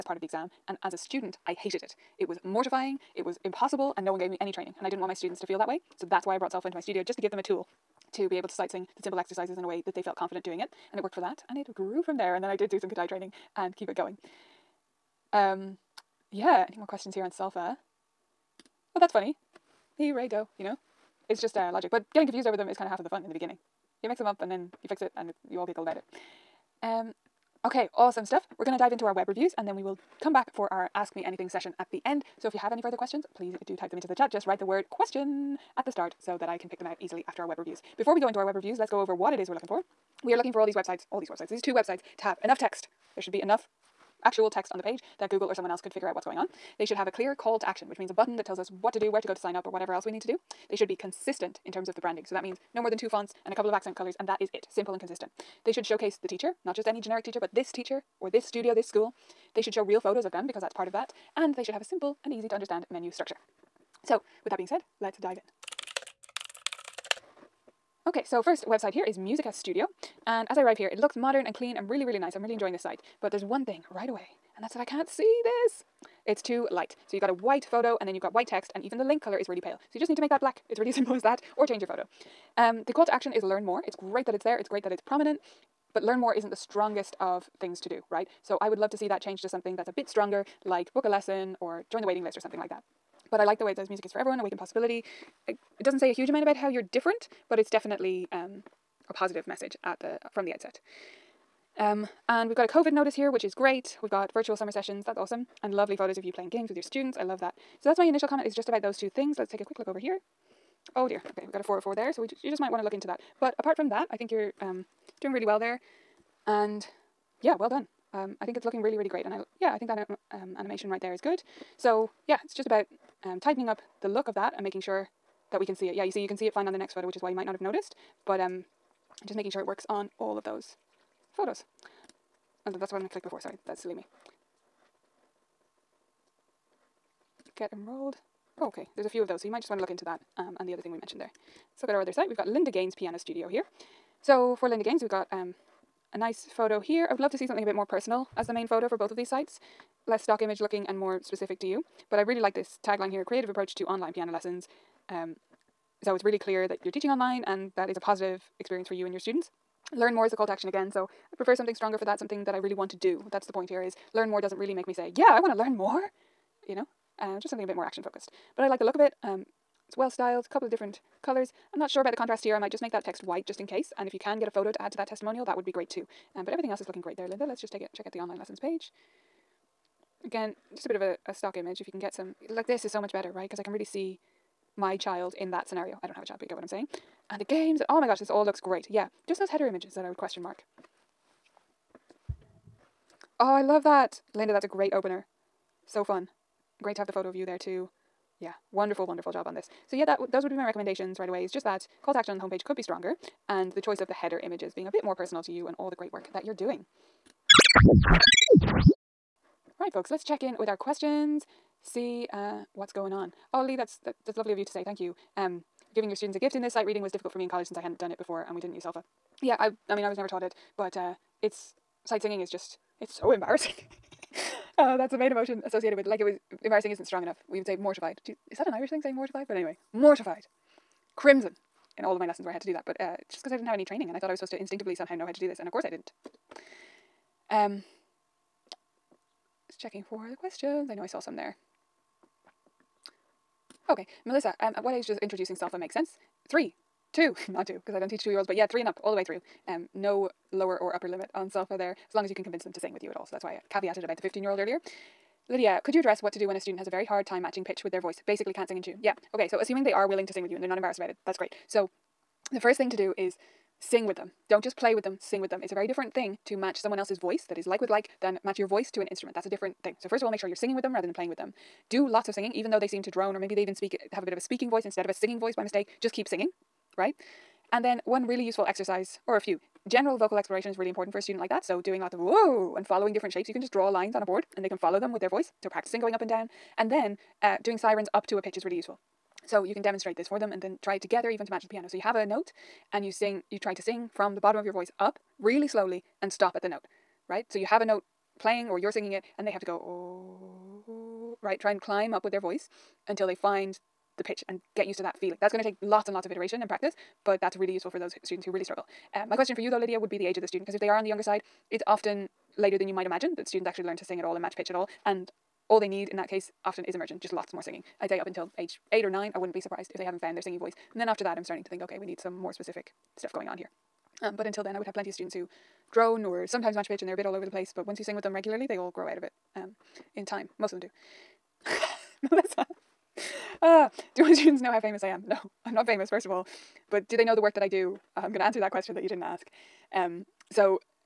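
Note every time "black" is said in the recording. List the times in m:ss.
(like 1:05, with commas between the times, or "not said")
1:20.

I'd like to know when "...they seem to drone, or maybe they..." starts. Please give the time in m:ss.
4:32.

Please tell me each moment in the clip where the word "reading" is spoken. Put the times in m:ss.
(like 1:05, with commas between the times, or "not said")
3:36.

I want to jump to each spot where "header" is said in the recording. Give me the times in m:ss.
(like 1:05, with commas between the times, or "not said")
3:09, 3:24.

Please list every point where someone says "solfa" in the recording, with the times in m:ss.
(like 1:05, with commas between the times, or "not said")
0:06, 0:17, 3:38, 4:05, 4:11.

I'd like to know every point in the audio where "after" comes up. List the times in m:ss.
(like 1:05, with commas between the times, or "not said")
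0:37, 5:21.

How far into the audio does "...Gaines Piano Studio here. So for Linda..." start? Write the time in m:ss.
2:22.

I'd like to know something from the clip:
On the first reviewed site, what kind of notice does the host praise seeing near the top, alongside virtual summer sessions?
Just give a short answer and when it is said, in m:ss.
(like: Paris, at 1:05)
COVID notice, at 1:42.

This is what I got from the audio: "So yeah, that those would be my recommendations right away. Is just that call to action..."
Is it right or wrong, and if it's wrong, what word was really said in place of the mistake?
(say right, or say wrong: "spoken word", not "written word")
right.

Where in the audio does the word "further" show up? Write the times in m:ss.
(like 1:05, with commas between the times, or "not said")
0:32.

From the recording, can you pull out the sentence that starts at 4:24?
Don't just play with them, sing with them.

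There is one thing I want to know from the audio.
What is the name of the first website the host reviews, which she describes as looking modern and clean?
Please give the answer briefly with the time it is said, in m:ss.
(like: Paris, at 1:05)
Musica Studio, at 1:09.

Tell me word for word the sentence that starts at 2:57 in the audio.
Let's just take it check out the online lessons page.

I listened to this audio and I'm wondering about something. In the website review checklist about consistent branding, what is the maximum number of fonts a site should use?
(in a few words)
2.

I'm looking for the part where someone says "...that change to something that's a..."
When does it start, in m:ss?
1:29.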